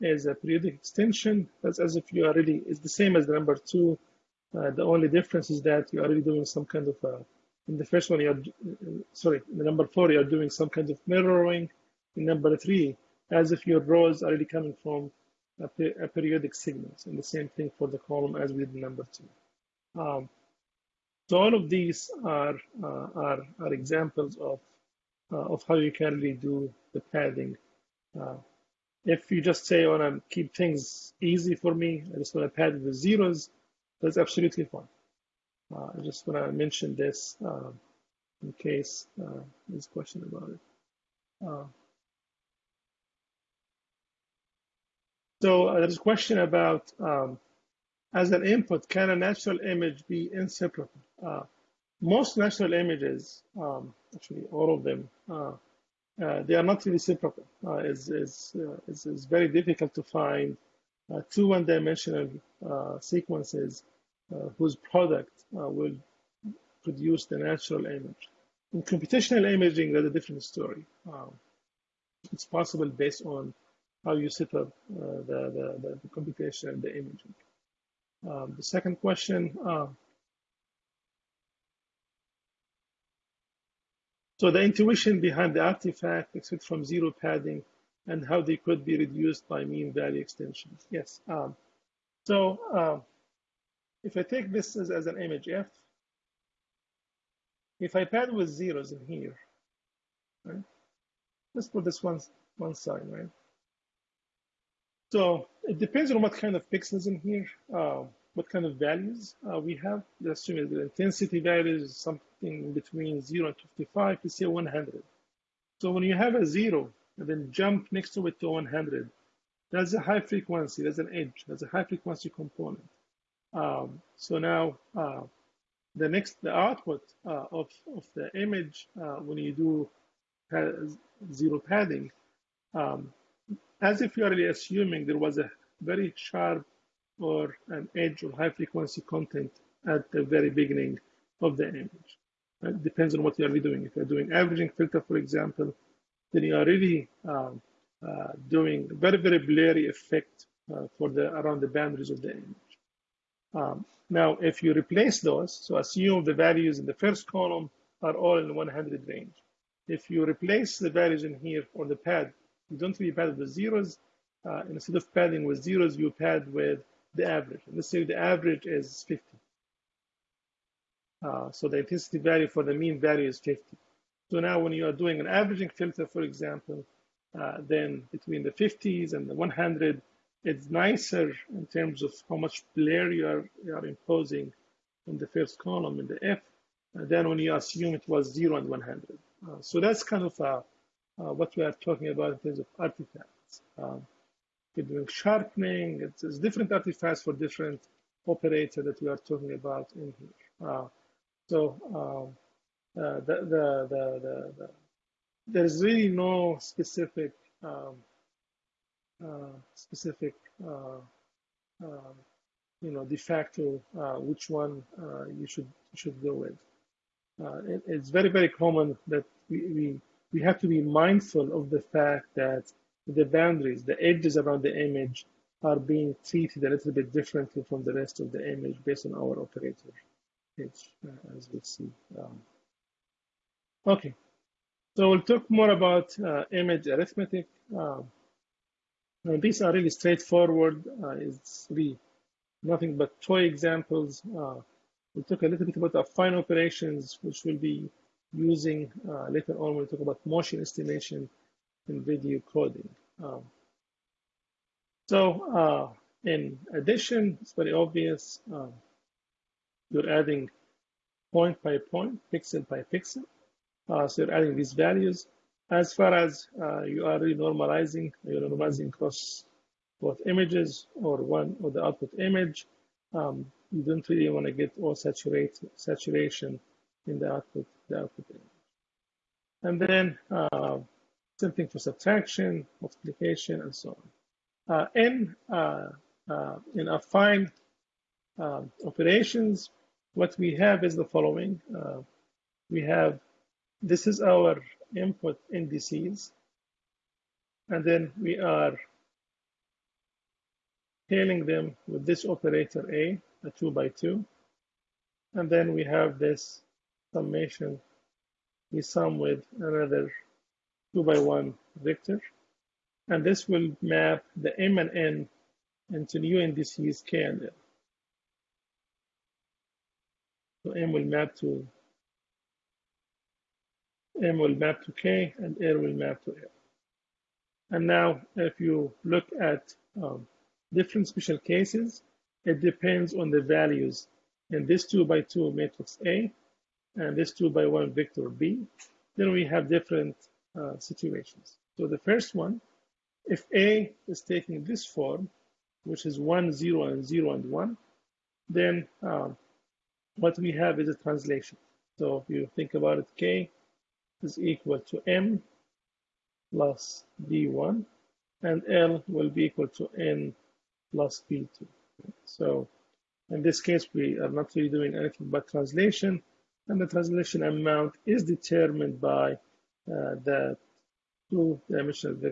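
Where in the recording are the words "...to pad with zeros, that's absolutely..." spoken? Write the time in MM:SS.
00:32.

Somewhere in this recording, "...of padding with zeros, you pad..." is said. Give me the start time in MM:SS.
02:44.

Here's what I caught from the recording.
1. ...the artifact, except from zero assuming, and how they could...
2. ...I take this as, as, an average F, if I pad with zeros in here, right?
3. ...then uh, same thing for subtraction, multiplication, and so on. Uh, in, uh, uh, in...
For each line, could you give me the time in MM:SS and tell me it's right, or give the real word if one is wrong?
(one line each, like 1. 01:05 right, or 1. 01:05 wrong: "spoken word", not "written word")
1. 01:25 wrong: "padding", not "assuming"
2. 01:34 wrong: "image", not "average"
3. 04:39 right.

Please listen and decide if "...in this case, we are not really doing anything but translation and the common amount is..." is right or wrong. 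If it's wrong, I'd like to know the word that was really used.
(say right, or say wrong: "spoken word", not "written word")
wrong: "translation", not "common".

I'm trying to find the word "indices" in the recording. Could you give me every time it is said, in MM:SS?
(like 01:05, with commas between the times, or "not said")
04:55, 05:16.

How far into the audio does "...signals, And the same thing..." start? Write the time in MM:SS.
00:16.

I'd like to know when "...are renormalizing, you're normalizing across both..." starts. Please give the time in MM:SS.
04:27.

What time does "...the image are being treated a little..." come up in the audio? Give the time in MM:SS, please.
03:44.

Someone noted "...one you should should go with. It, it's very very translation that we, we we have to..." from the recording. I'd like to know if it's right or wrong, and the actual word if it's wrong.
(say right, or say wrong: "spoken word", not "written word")
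wrong: "common", not "translation".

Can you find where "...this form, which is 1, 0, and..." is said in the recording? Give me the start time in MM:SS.
05:44.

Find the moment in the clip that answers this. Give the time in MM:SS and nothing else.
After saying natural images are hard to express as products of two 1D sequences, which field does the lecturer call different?
01:08.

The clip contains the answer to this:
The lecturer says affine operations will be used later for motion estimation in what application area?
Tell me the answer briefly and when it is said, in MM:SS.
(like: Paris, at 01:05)
Video coding, at 04:12.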